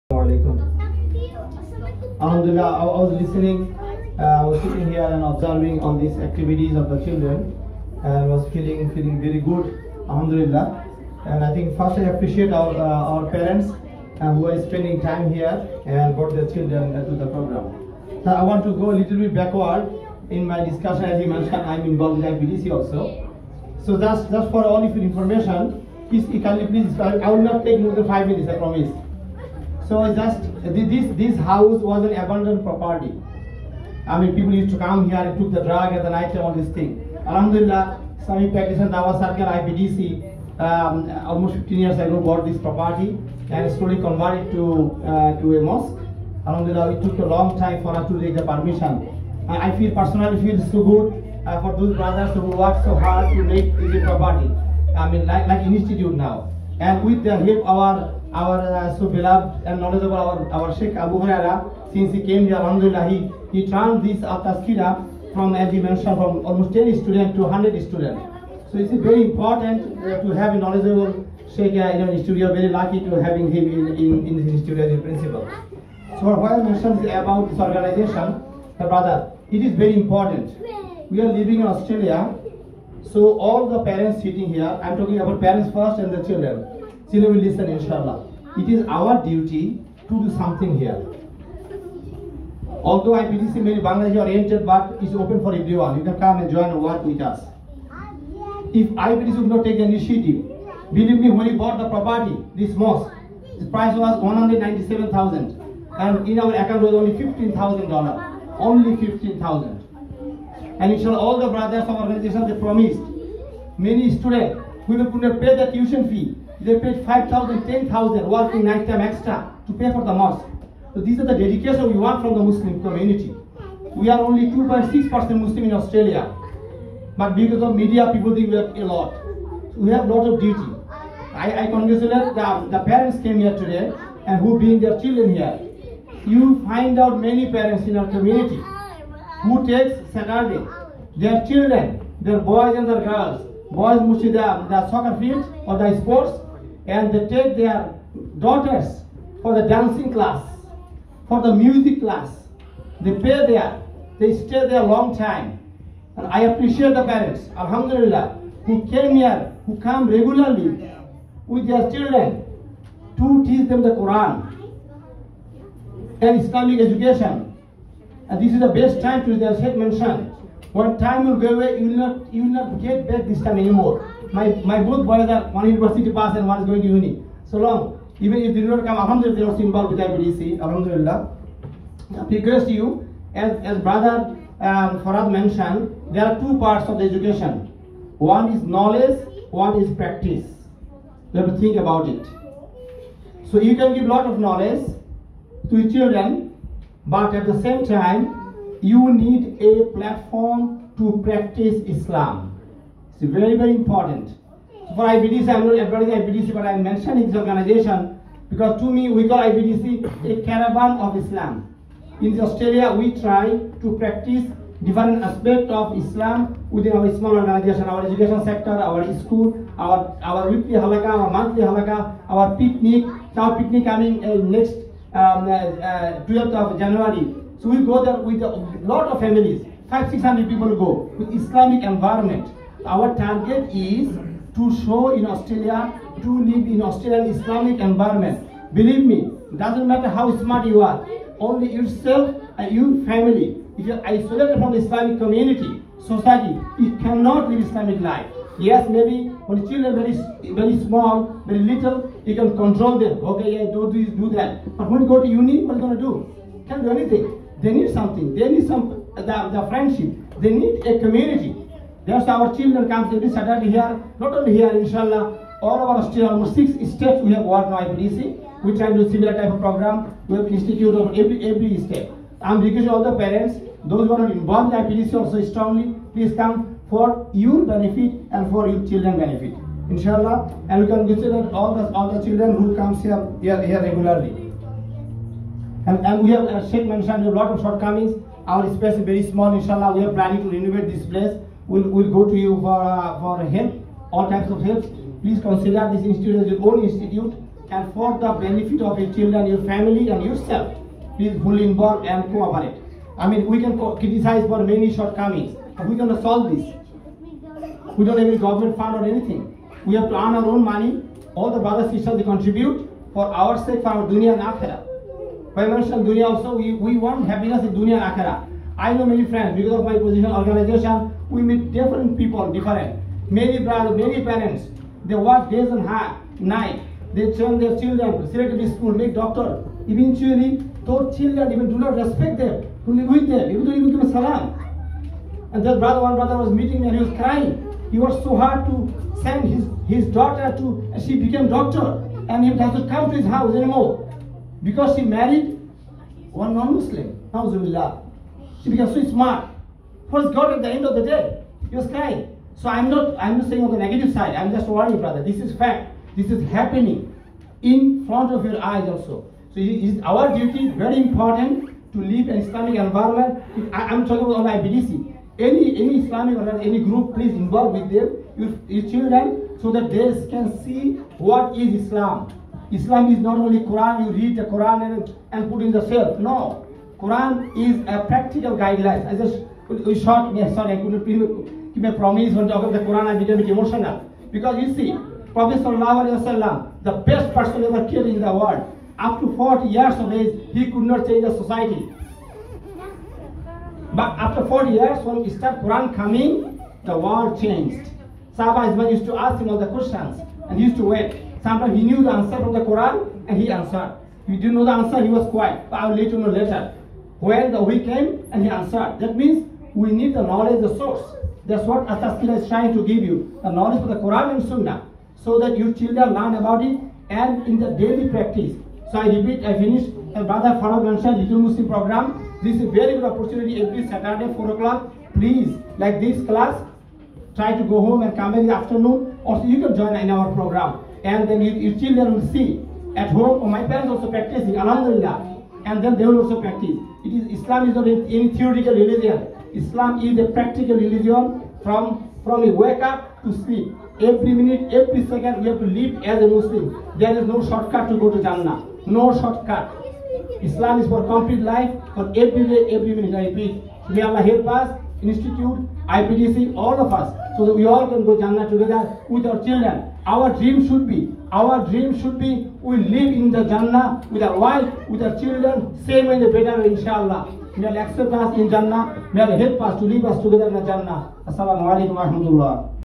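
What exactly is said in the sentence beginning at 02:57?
So long, even if they do not come, Alhamdulillah, they are also involved with IPDC, Alhamdulillah.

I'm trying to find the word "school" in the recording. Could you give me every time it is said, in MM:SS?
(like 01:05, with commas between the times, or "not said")
03:39, 05:28.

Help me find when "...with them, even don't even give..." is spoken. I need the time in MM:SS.
05:33.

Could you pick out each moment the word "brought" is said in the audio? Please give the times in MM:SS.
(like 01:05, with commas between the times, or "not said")
00:16.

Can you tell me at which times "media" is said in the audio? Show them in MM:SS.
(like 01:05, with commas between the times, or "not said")
02:07.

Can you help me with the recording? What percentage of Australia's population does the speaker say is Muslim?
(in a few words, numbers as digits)
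2.6%.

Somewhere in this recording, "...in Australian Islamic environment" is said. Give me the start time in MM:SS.
03:56.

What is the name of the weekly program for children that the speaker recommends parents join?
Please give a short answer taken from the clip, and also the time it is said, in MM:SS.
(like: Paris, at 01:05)
Little Muslim program, at 07:01.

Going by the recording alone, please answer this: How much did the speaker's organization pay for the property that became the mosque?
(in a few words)
197000.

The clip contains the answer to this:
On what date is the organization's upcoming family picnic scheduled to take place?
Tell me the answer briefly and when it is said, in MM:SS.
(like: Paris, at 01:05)
12th of January, at 03:46.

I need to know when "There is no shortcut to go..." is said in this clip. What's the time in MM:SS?
07:26.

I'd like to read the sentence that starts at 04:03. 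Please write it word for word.
If you're isolated from the Islamic community, society, you cannot live Islamic life.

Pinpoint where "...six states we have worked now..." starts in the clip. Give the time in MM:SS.
04:26.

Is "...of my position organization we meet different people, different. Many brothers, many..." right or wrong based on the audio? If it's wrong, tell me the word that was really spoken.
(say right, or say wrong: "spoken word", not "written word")
right.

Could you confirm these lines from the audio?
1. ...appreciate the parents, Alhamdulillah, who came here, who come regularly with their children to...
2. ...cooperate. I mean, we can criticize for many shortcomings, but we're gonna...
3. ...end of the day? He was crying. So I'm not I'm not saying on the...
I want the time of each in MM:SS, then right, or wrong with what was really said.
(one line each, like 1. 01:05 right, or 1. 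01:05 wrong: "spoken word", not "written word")
1. 02:36 right
2. 05:02 right
3. 05:50 right.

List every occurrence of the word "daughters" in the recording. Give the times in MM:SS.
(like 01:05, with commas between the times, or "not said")
02:28, 05:40.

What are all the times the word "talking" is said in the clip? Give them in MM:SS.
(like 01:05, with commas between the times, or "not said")
01:24, 06:04, 06:22.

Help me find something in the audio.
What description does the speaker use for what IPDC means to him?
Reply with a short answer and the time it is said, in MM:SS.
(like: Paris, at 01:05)
a caravan of Islam, at 03:30.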